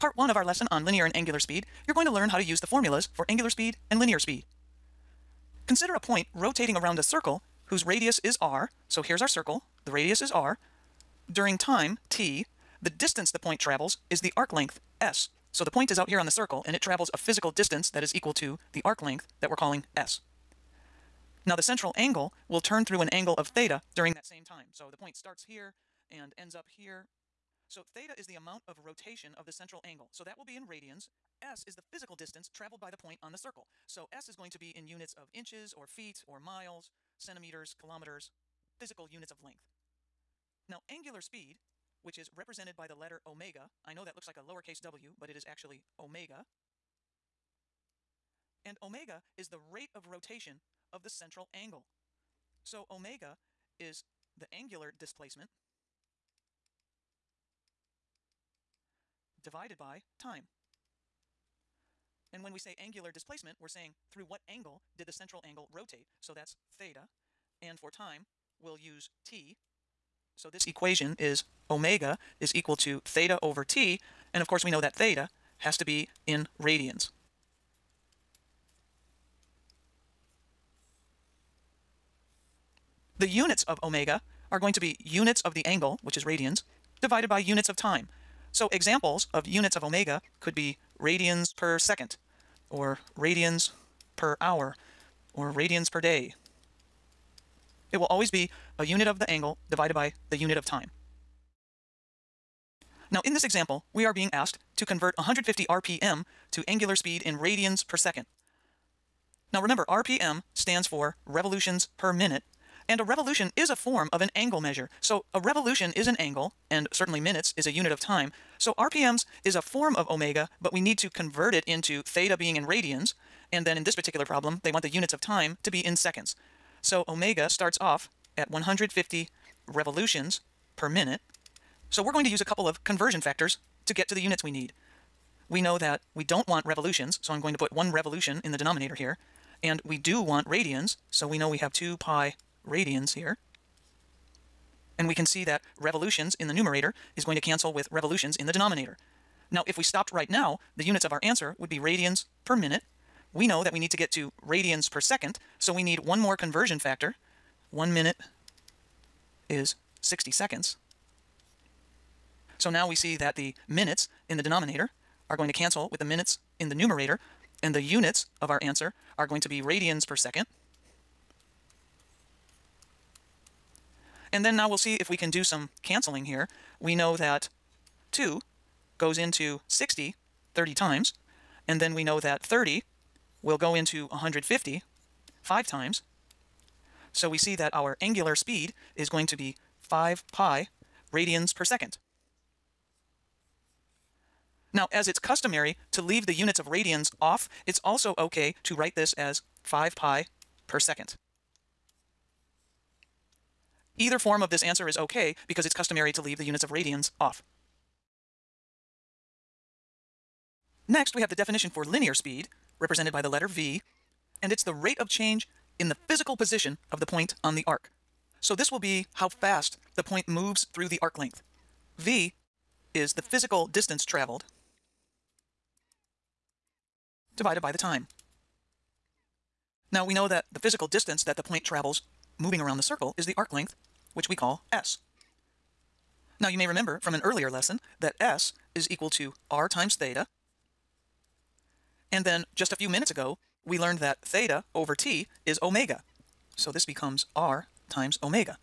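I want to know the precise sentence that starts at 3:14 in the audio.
Now, as it's customary to leave the units of radians off, it's also okay to write this as 5 pi per second.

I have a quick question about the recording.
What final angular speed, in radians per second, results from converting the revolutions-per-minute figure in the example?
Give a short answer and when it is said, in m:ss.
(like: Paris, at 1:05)
5 pi radians per second, at 3:09.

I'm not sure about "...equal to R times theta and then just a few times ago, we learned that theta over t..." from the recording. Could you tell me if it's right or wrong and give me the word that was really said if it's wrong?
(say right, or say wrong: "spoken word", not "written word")
wrong: "minutes", not "times".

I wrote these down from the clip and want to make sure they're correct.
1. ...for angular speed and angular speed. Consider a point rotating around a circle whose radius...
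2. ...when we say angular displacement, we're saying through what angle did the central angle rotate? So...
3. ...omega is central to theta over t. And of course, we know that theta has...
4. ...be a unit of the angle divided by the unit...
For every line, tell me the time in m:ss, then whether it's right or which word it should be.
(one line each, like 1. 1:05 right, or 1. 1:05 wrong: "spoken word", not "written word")
1. 0:03 wrong: "linear", not "angular"
2. 1:02 right
3. 1:11 wrong: "equal", not "central"
4. 1:38 right.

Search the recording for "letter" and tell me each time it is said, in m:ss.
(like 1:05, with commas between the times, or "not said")
0:42, 3:33.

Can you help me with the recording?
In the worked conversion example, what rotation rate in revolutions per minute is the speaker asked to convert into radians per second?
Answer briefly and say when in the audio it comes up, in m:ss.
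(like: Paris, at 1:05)
150 RPM, at 1:45.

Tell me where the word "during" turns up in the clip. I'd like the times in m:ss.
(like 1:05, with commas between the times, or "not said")
0:11, 0:23.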